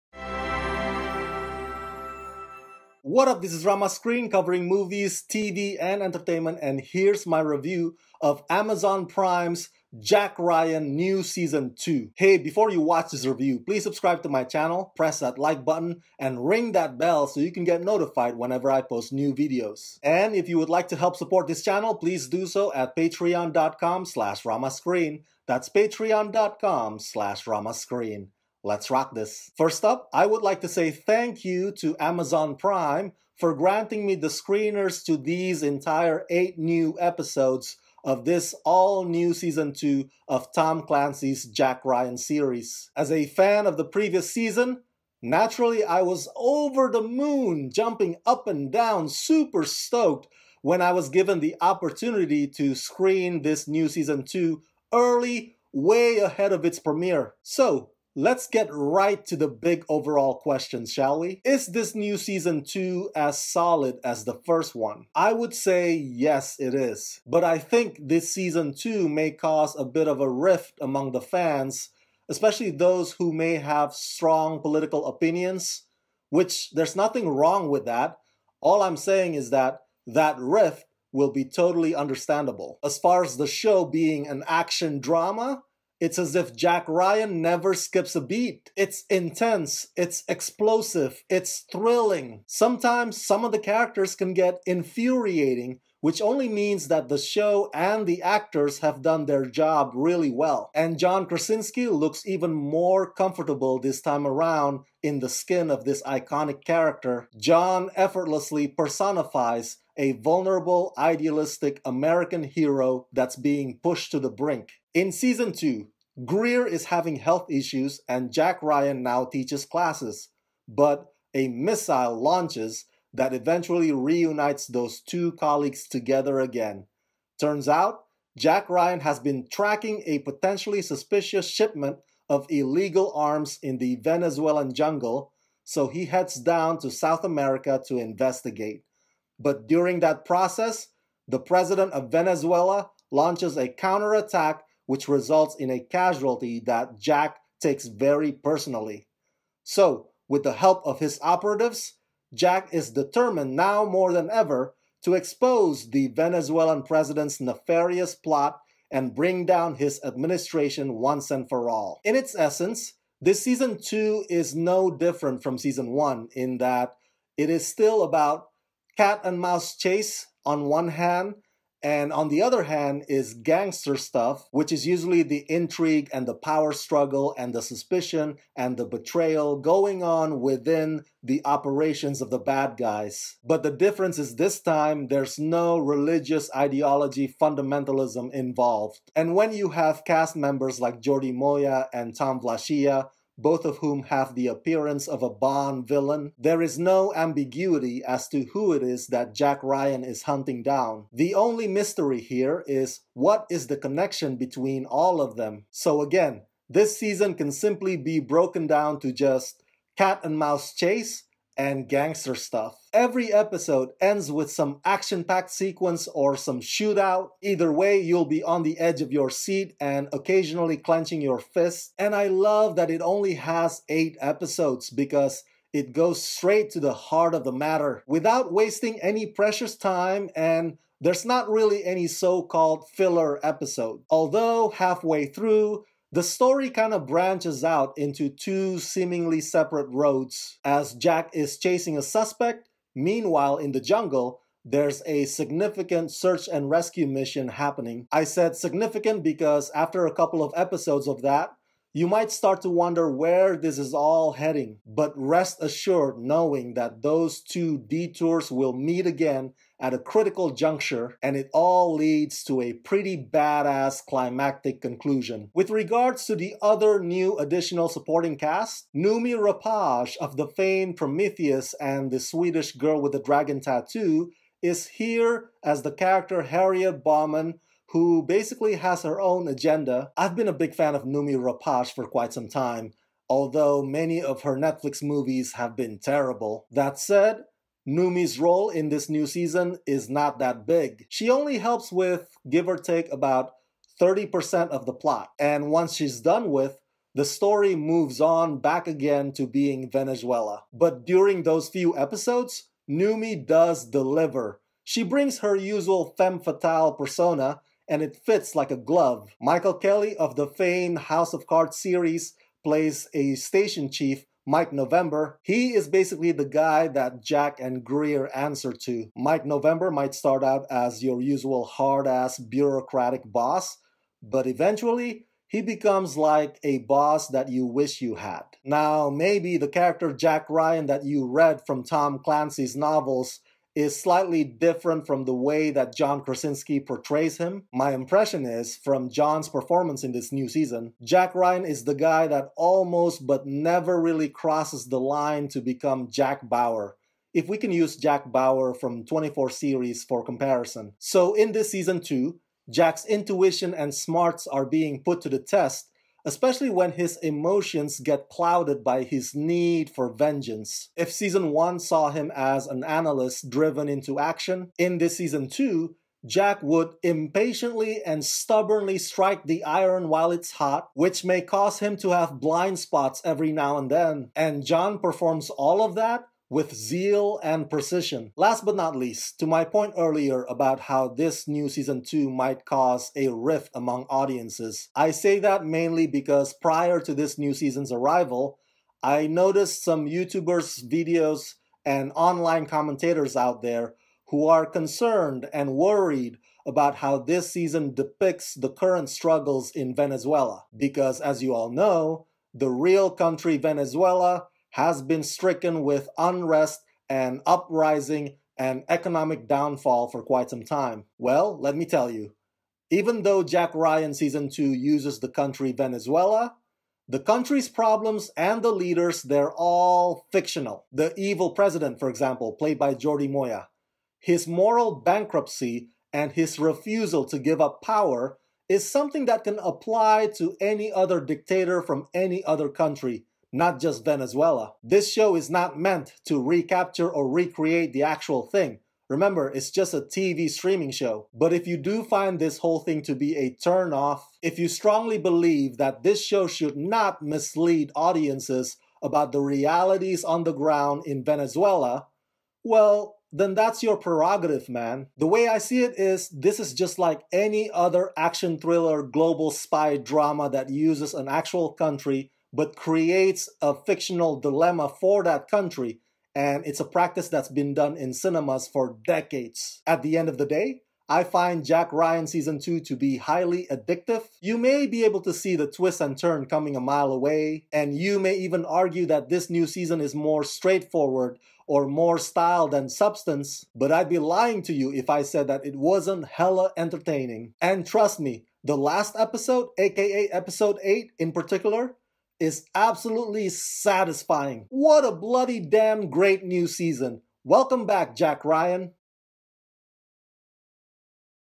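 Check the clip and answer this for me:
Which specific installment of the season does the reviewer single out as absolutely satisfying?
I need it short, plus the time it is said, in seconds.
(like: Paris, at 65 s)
Episode 8, at 490 s.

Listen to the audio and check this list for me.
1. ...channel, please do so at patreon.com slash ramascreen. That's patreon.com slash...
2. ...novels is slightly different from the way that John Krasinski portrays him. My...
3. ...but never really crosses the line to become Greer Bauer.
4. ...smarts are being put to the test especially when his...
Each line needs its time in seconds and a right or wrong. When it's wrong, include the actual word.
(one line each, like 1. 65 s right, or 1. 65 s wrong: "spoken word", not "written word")
1. 21 s right
2. 332 s right
3. 343 s wrong: "Jack", not "Greer"
4. 353 s right.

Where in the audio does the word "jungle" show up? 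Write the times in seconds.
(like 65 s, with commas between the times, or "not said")
134 s, 243 s.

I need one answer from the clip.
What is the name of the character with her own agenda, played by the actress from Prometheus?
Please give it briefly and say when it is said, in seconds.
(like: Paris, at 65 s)
Harriet Bauman, at 276 s.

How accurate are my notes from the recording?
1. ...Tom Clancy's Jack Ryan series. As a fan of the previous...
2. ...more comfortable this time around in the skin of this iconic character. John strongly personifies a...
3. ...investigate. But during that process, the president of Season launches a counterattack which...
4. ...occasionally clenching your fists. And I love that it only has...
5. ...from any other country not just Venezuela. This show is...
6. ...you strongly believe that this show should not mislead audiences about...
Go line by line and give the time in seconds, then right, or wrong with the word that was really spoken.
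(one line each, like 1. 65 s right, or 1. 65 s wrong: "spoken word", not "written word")
1. 40 s right
2. 102 s wrong: "effortlessly", not "strongly"
3. 137 s wrong: "Venezuela", not "Season"
4. 220 s right
5. 431 s right
6. 444 s right.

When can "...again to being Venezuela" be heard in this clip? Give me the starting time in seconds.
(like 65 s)
298 s.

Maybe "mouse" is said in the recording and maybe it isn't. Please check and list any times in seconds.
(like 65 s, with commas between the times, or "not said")
169 s, 210 s.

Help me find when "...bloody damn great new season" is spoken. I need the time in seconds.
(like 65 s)
495 s.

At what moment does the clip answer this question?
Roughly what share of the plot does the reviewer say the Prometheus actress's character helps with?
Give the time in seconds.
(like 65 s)
293 s.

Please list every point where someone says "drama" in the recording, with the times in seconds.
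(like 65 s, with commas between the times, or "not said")
84 s, 459 s.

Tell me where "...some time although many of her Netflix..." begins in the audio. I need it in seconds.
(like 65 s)
282 s.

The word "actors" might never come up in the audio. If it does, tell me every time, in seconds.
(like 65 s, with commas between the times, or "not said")
98 s.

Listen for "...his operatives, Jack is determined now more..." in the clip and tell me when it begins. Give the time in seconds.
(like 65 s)
150 s.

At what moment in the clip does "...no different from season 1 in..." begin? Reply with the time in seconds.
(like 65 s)
164 s.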